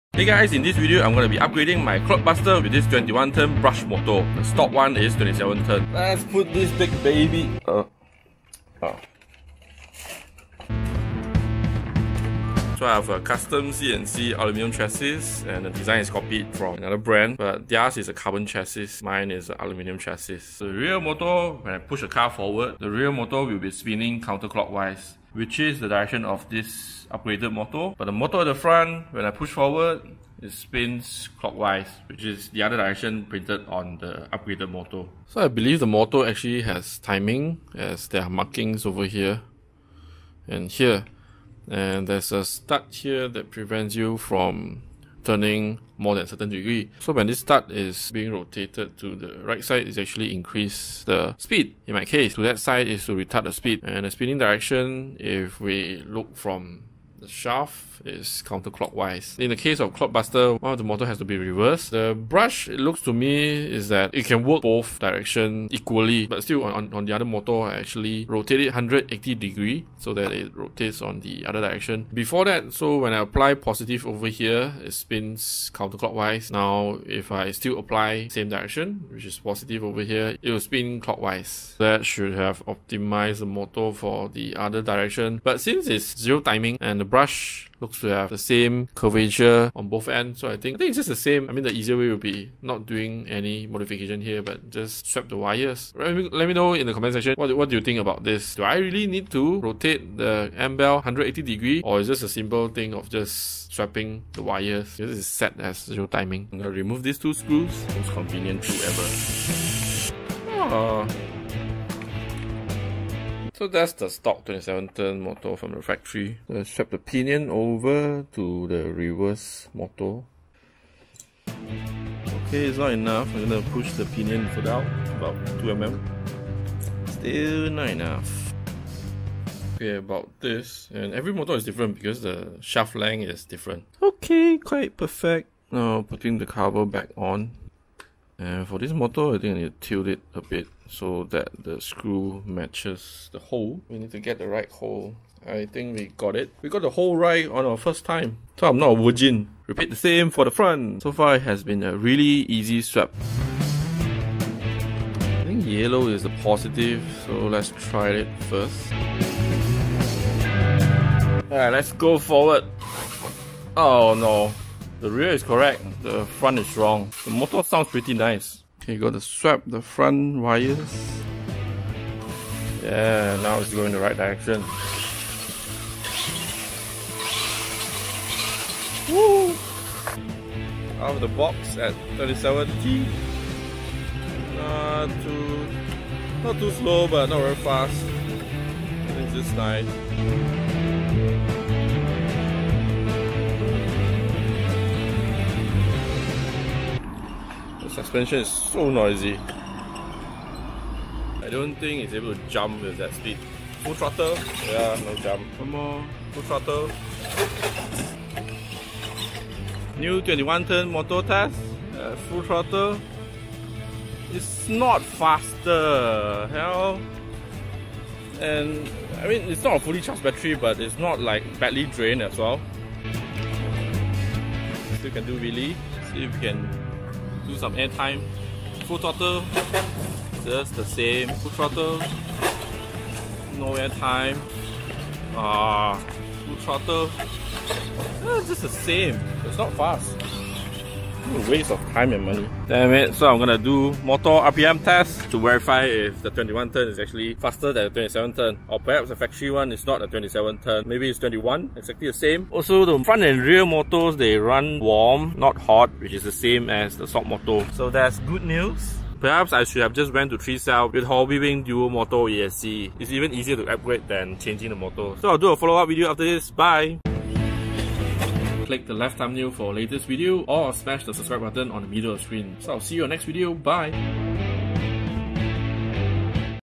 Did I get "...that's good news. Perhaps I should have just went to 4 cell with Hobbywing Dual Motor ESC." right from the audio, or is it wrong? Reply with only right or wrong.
wrong.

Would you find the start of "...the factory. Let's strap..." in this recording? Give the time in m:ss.
1:55.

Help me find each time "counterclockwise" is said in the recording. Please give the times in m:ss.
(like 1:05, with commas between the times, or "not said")
0:24, 0:58, 1:15.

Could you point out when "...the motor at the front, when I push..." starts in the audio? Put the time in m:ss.
0:28.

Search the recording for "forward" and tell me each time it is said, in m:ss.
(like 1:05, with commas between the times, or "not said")
0:22, 0:29, 2:42.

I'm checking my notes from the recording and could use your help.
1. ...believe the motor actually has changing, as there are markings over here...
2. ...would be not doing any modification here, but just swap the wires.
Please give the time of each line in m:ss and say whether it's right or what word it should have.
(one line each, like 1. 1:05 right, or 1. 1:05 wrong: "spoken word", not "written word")
1. 0:35 wrong: "timing", not "changing"
2. 1:32 right.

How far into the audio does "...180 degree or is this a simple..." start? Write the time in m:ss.
1:41.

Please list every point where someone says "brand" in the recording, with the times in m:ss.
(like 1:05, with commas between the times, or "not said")
0:16.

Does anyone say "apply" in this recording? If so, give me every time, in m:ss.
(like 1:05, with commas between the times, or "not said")
1:13, 1:17.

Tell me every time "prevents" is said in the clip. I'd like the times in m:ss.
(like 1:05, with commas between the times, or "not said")
0:43.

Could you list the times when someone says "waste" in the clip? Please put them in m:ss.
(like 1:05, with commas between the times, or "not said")
4:01.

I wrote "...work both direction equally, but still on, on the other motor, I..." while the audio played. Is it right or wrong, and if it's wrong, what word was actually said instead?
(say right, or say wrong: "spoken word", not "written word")
right.